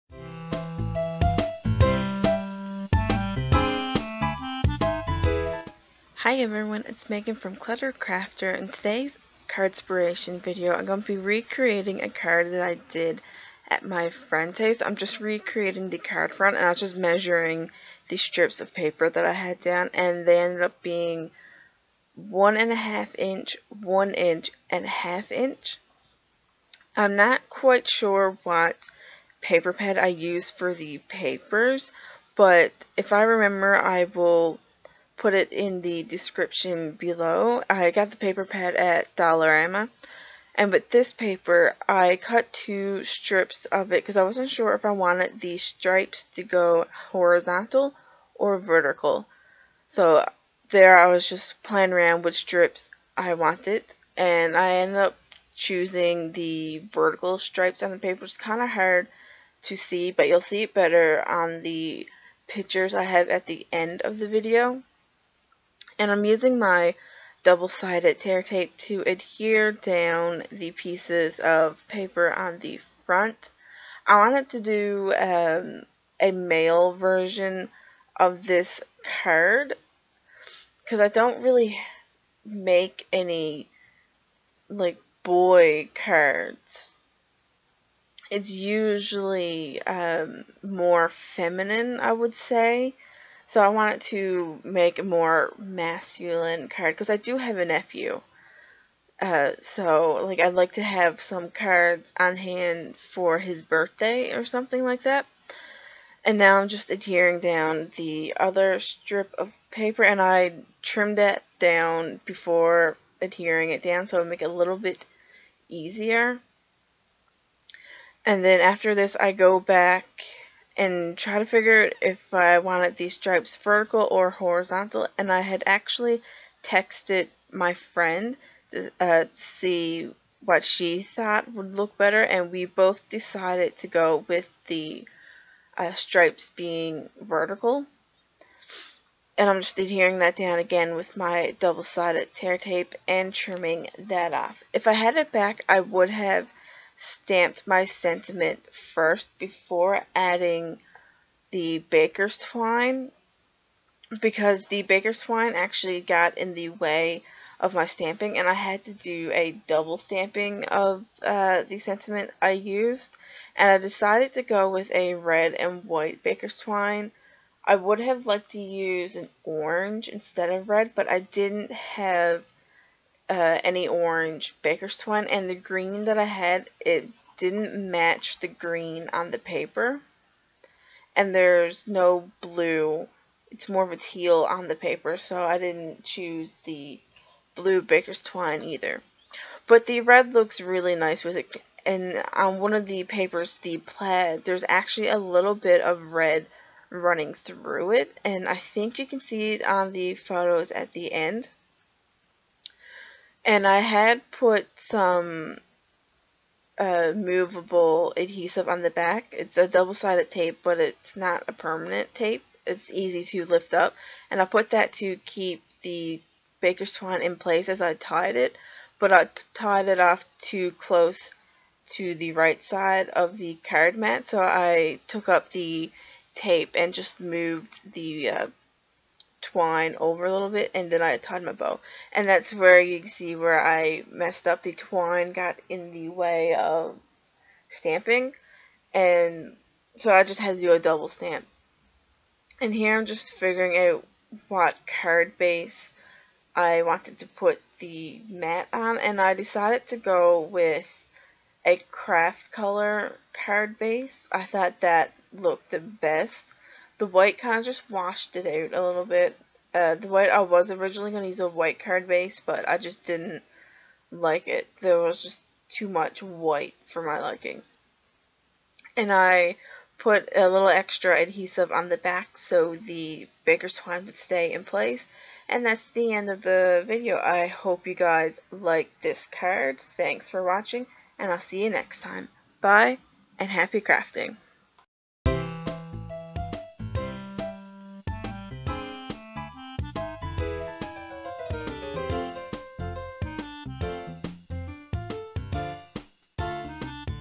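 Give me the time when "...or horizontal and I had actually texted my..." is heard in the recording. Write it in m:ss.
2:04.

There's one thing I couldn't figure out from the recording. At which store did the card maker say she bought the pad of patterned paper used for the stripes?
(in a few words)
Dollarama.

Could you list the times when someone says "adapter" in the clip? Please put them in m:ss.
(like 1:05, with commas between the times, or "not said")
not said.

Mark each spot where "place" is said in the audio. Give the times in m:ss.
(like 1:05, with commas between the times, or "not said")
3:37, 4:34.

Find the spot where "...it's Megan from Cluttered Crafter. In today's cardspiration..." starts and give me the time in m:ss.
0:06.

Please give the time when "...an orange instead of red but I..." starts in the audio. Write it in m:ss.
2:49.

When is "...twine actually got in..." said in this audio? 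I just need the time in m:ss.
2:35.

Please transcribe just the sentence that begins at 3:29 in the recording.
It's a double-sided tape, but it's not a permanent tape.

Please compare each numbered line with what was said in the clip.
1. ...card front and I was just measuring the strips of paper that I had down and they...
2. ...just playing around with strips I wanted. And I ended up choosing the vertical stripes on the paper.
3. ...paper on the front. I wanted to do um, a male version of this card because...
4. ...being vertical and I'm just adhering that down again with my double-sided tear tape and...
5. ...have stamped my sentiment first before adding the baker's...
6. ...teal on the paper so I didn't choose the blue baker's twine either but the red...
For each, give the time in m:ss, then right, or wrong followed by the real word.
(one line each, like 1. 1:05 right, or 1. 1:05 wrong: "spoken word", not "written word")
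1. 0:15 right
2. 0:51 right
3. 1:11 right
4. 2:16 right
5. 2:26 right
6. 3:03 right.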